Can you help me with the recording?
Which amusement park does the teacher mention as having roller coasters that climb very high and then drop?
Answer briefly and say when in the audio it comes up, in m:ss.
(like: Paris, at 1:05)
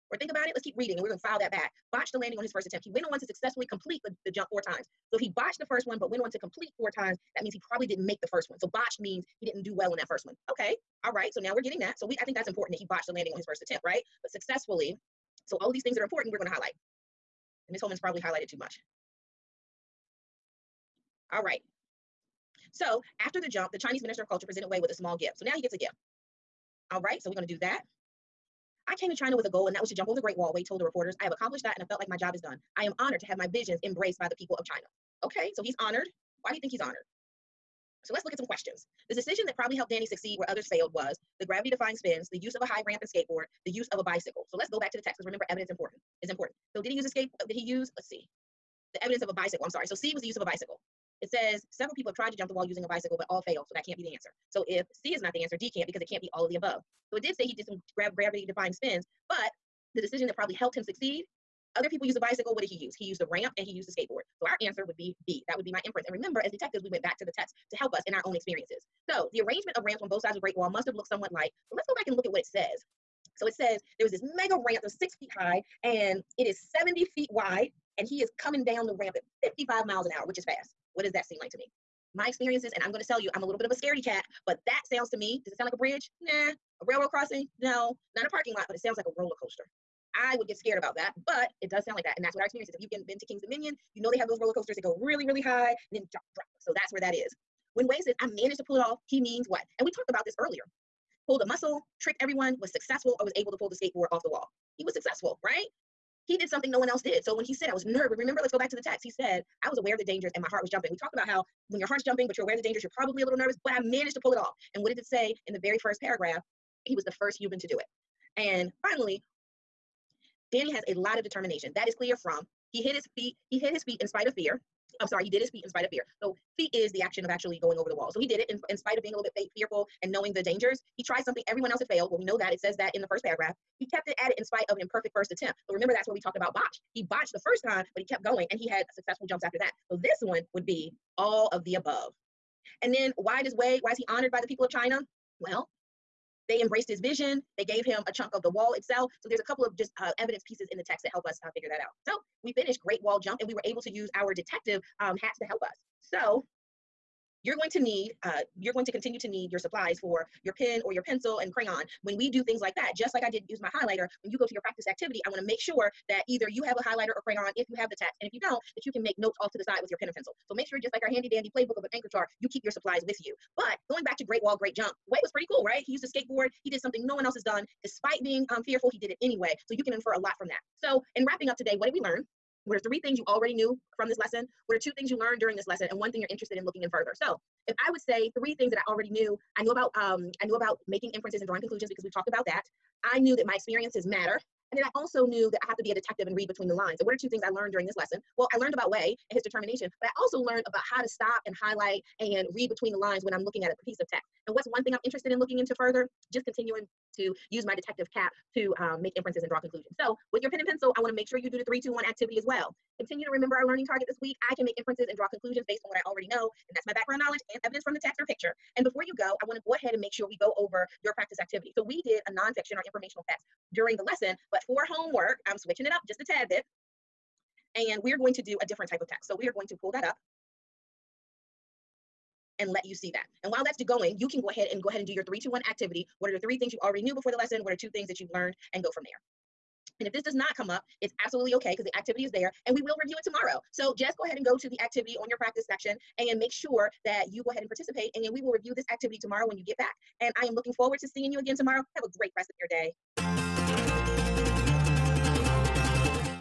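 King's Dominion, at 1:33.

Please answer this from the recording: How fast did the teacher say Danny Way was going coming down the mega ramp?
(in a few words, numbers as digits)
55 miles an hour.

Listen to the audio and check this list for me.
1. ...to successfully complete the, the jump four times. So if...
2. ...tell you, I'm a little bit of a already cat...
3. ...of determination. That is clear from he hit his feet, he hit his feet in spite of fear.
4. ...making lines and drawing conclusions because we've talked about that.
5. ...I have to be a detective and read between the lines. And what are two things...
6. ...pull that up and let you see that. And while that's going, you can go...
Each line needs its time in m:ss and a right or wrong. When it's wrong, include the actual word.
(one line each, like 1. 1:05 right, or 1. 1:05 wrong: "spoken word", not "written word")
1. 0:03 right
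2. 1:23 wrong: "scaredy", not "already"
3. 2:01 right
4. 3:10 wrong: "inferences", not "lines"
5. 3:15 right
6. 3:49 right.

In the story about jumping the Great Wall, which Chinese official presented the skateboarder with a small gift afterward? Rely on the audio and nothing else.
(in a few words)
Chinese Minister of Culture.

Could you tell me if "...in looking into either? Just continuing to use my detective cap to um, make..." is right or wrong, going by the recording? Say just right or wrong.
wrong.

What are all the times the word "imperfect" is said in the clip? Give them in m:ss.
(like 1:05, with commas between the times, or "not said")
2:14.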